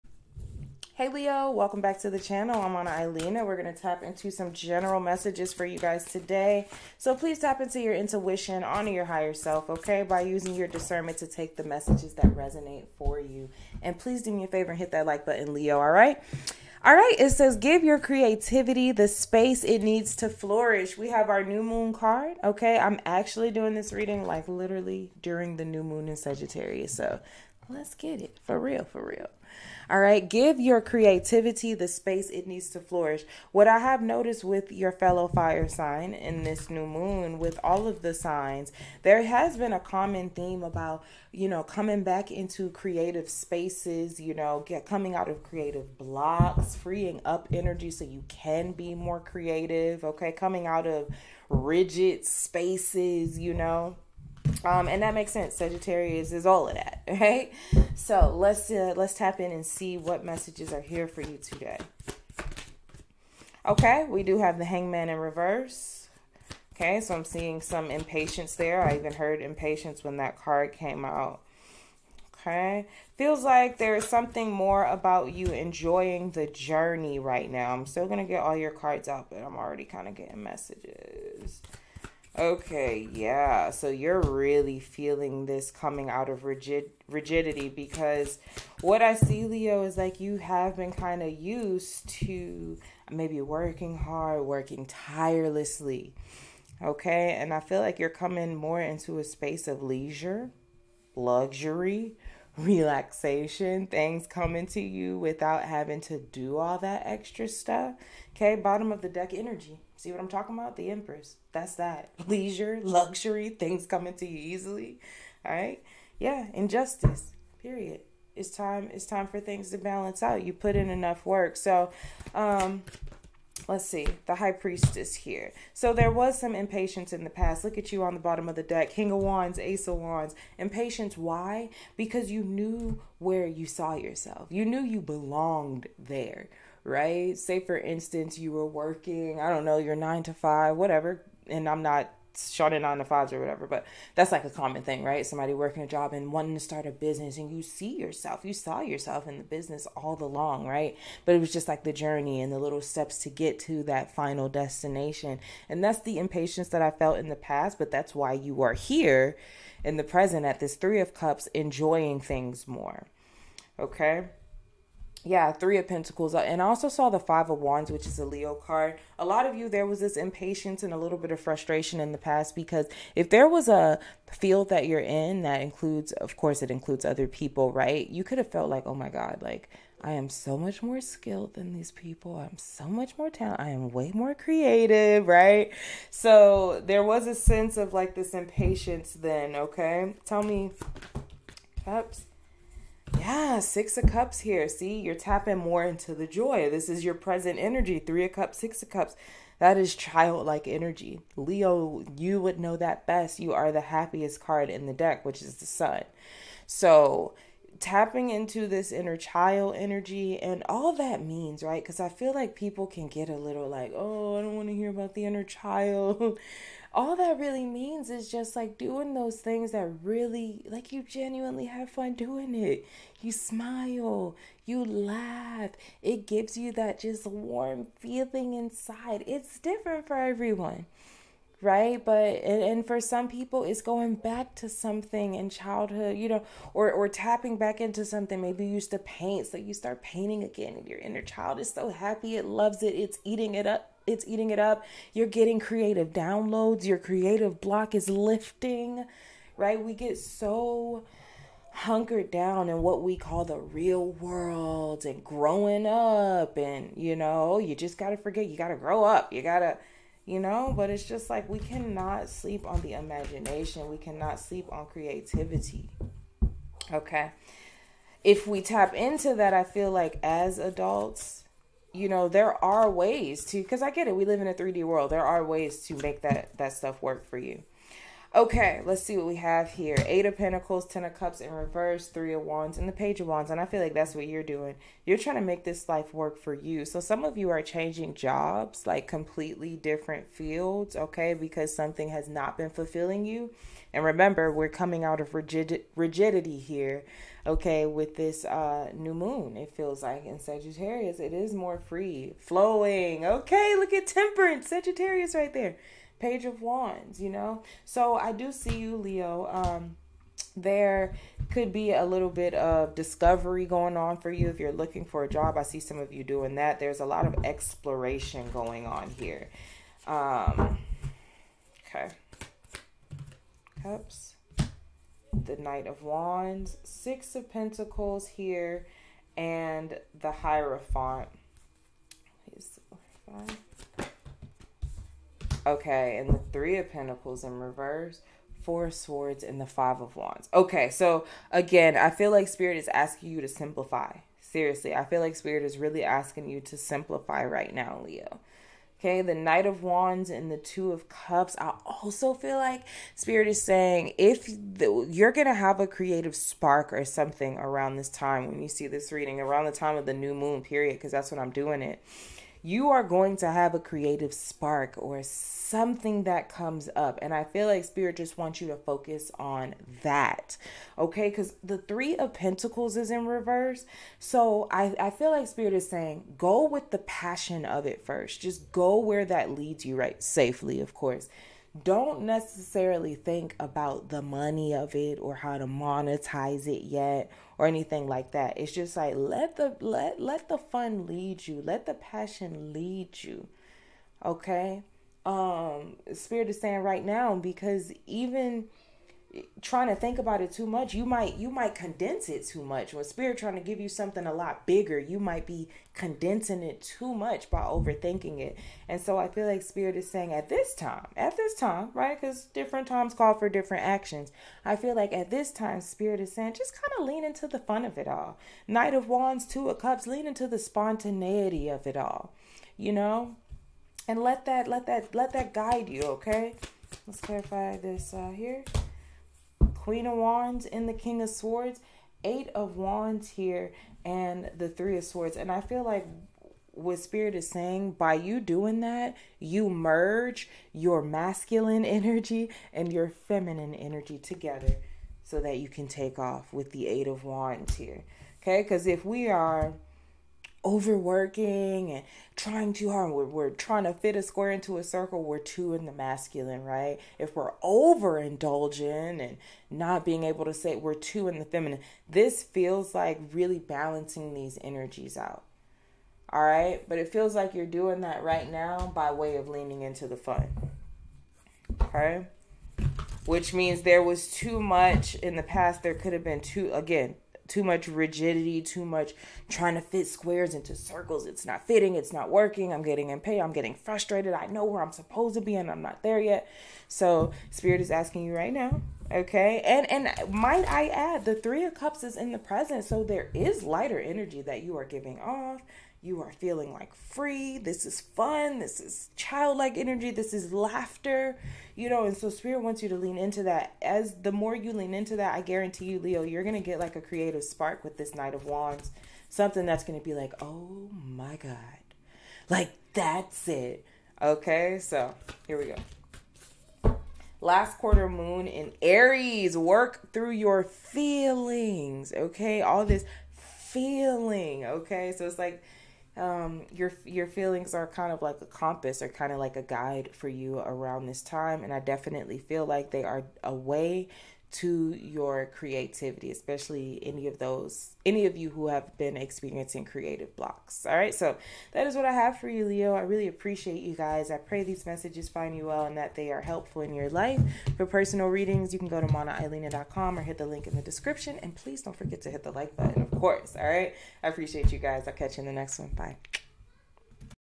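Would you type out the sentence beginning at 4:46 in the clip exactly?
So some of you are changing jobs, like completely different fields, okay, because something has not been fulfilling you.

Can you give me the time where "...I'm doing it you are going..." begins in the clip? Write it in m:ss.
6:01.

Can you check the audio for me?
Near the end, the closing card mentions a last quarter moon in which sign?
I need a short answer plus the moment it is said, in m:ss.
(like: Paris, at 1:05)
Aries, at 8:37.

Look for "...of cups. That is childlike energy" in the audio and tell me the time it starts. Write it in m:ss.
3:18.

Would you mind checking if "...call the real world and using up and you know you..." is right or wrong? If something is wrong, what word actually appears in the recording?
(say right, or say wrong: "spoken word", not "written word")
wrong: "growing", not "using".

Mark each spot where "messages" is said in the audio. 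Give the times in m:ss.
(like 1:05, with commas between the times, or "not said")
0:04, 0:11, 1:00, 1:20, 9:04.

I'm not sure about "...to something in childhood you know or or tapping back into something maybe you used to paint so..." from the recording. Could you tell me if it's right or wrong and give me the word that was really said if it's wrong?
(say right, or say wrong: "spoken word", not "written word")
right.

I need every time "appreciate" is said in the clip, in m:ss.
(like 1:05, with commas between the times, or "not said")
9:03, 9:14.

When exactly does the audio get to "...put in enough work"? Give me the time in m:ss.
2:00.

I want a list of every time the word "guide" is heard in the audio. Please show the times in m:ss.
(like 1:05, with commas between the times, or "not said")
7:05, 8:49.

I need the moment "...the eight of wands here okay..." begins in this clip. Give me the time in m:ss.
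7:26.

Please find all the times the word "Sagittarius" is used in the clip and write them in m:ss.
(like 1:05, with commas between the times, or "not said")
0:26, 0:55, 5:00, 5:04.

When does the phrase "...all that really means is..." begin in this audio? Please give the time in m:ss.
3:36.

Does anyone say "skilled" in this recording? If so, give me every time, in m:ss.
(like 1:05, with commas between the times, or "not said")
3:01.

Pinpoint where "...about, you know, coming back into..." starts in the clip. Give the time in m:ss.
0:40.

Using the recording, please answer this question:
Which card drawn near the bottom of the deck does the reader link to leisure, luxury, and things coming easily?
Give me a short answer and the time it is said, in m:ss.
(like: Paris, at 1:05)
The Empress, at 1:50.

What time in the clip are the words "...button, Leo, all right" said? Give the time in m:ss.
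0:15.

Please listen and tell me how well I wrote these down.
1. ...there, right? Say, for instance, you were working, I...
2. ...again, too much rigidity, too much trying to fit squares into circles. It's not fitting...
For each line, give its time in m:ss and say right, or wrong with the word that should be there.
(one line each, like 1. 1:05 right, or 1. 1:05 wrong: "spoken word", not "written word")
1. 2:15 right
2. 7:56 right.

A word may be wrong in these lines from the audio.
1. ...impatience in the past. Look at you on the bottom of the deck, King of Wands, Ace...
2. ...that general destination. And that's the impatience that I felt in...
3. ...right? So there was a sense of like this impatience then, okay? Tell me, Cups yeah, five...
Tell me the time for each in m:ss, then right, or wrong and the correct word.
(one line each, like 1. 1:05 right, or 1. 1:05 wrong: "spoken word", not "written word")
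1. 2:06 right
2. 2:33 wrong: "final", not "general"
3. 3:05 wrong: "six", not "five".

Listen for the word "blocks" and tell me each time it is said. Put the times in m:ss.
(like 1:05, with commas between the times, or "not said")
0:45, 4:07, 9:00.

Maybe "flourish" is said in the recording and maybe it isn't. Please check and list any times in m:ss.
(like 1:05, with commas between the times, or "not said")
0:20, 0:32.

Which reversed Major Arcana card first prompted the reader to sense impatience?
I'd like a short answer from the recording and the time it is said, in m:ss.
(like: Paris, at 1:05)
The Hangman, at 1:04.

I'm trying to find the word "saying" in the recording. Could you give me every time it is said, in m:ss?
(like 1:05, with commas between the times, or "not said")
5:53, 6:15, 6:36, 6:50, 6:56, 7:17.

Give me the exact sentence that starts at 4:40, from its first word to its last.
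Eight of Pentacles, Ten of Cups in reverse, Three of Wands, and the Page of Wands.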